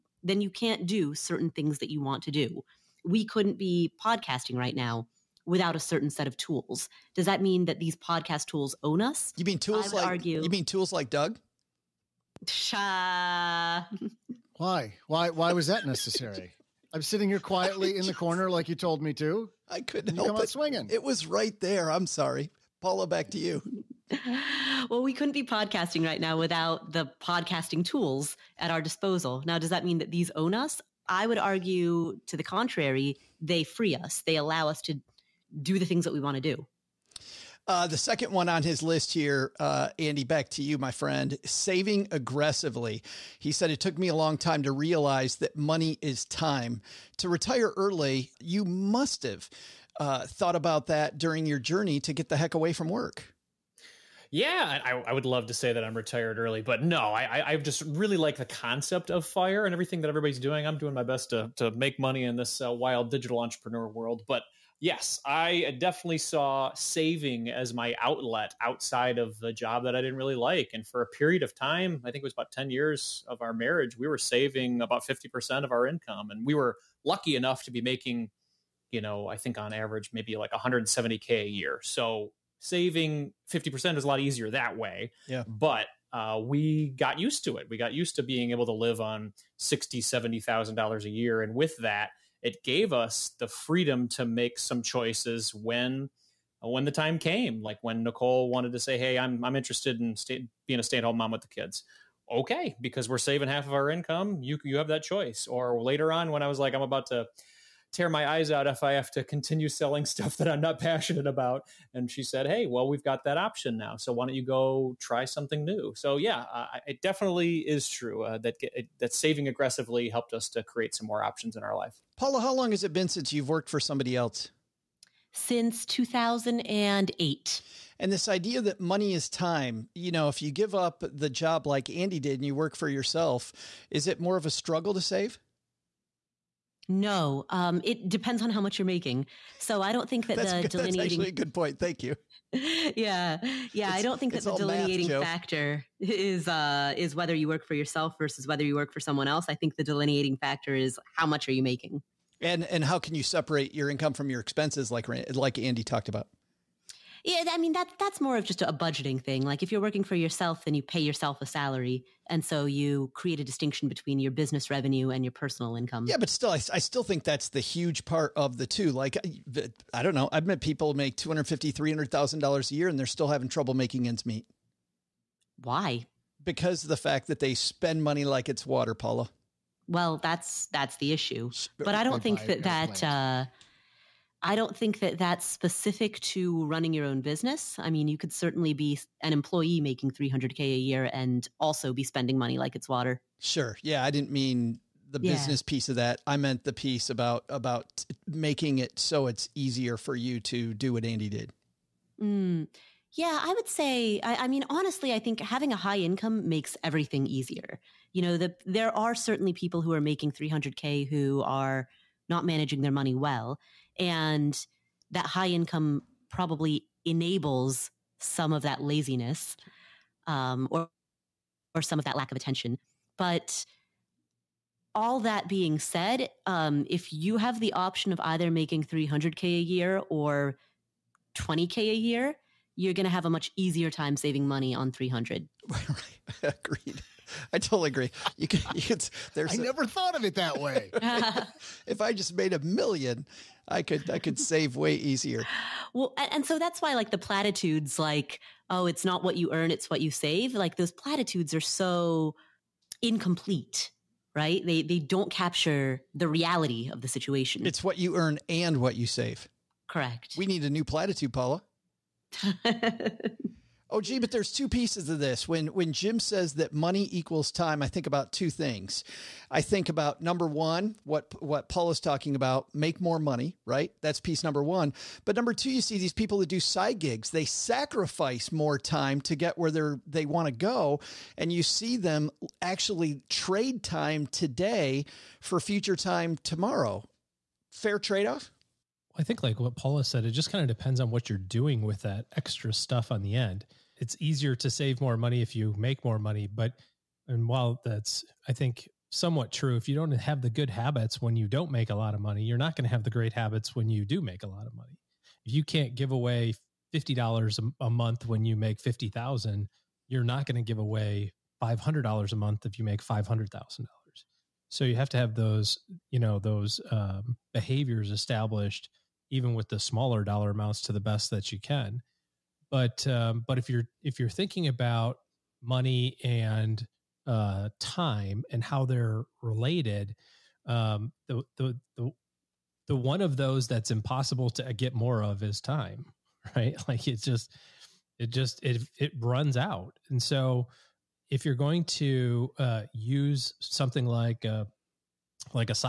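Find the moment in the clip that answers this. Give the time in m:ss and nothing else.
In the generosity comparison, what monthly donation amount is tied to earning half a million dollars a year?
5:11.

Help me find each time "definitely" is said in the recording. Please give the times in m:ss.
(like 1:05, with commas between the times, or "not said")
1:05, 1:57.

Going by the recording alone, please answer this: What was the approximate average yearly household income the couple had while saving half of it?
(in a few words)
170K.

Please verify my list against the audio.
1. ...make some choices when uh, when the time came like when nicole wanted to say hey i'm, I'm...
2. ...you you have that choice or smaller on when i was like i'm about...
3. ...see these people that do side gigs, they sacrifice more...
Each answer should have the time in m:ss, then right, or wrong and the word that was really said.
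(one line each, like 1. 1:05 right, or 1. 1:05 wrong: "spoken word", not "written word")
1. 1:34 right
2. 1:44 wrong: "later", not "smaller"
3. 4:35 right.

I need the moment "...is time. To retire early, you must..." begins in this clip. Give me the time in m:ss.
0:46.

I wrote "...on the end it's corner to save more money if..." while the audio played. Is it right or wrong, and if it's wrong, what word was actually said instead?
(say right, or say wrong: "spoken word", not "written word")
wrong: "easier", not "corner".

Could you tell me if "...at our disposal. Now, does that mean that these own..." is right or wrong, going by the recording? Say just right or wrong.
right.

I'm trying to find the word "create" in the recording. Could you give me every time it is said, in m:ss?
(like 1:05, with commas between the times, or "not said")
2:00, 2:43.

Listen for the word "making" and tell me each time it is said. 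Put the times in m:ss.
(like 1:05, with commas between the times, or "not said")
1:17, 2:18, 2:31, 2:53, 3:09, 3:18, 3:30, 3:48.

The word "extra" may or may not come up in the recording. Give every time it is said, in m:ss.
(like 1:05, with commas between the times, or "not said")
4:52.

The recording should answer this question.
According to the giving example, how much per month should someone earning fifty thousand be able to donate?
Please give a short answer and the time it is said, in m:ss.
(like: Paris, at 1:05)
$50, at 5:06.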